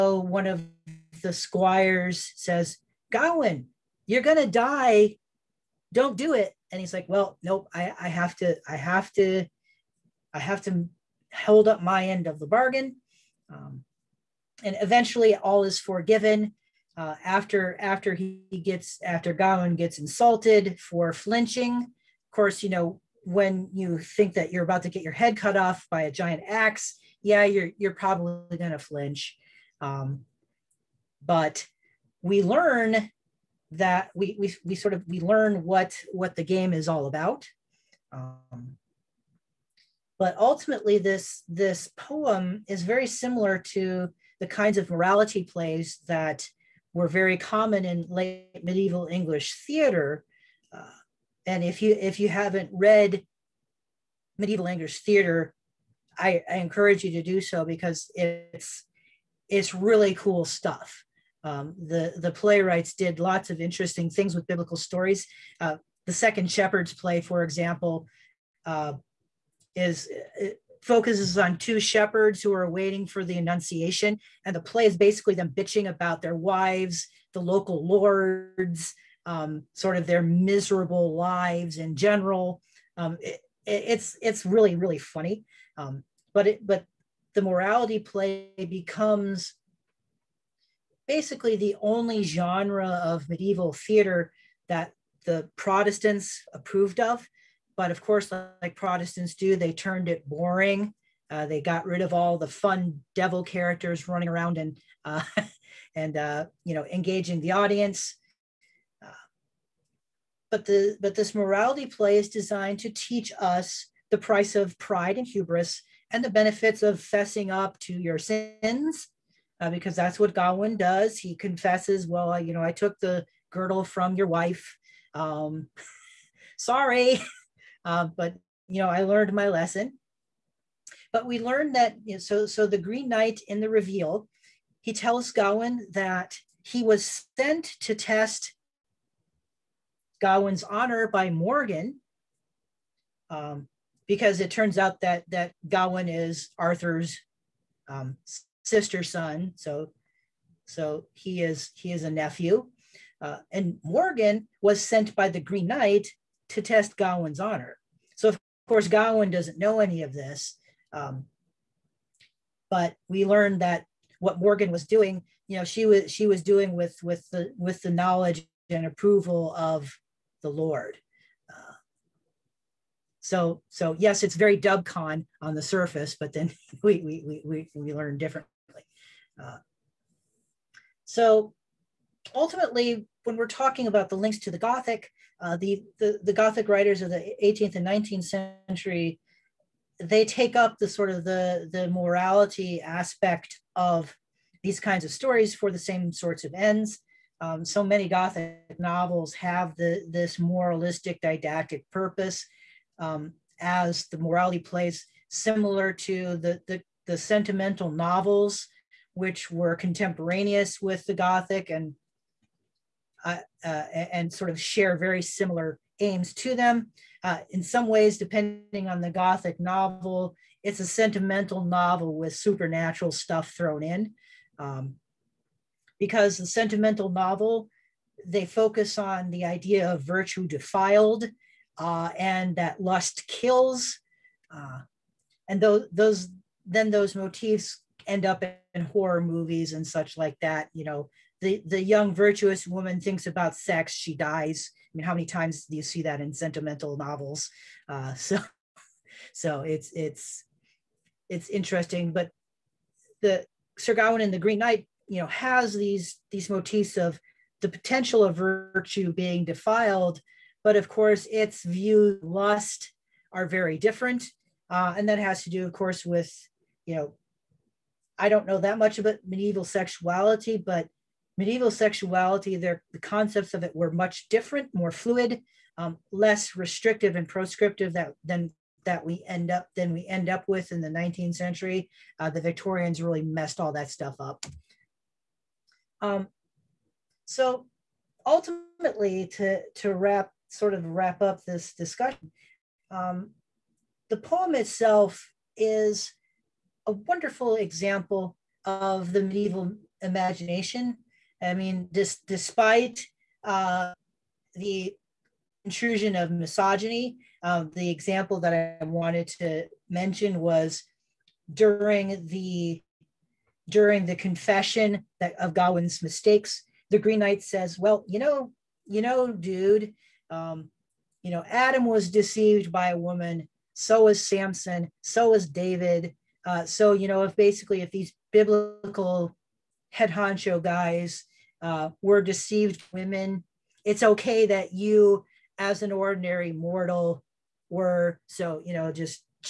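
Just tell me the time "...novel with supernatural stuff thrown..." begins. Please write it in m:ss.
3:41.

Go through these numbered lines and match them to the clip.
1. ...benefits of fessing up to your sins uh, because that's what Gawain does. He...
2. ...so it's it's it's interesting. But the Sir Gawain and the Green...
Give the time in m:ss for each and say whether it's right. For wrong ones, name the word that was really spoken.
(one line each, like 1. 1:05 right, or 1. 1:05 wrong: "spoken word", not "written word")
1. 1:56 right
2. 4:09 right.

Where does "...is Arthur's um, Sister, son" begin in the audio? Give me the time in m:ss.
2:26.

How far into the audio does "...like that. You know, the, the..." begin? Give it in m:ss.
4:00.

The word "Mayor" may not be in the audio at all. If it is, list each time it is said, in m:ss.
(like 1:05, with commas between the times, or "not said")
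not said.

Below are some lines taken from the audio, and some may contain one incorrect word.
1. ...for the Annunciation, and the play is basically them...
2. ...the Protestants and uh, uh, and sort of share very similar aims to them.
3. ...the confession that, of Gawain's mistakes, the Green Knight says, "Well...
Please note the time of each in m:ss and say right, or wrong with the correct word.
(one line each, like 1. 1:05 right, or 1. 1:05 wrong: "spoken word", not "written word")
1. 1:13 right
2. 3:31 wrong: "Gothic", not "Protestants"
3. 5:14 right.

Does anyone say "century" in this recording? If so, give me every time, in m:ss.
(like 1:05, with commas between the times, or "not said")
3:08, 4:41.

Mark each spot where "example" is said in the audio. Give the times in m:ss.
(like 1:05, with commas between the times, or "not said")
1:07, 4:57, 5:07.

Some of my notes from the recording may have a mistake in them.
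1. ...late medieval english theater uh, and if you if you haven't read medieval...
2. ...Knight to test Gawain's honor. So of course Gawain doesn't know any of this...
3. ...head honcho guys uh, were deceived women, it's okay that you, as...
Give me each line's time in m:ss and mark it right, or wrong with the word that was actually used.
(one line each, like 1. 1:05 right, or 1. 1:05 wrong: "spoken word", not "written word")
1. 0:48 right
2. 2:35 right
3. 5:29 right.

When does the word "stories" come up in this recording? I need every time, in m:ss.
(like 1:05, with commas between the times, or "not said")
1:04, 3:15.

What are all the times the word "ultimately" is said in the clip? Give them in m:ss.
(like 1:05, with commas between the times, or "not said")
0:40, 3:02, 4:48.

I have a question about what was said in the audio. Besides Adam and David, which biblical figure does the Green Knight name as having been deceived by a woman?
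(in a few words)
Samson.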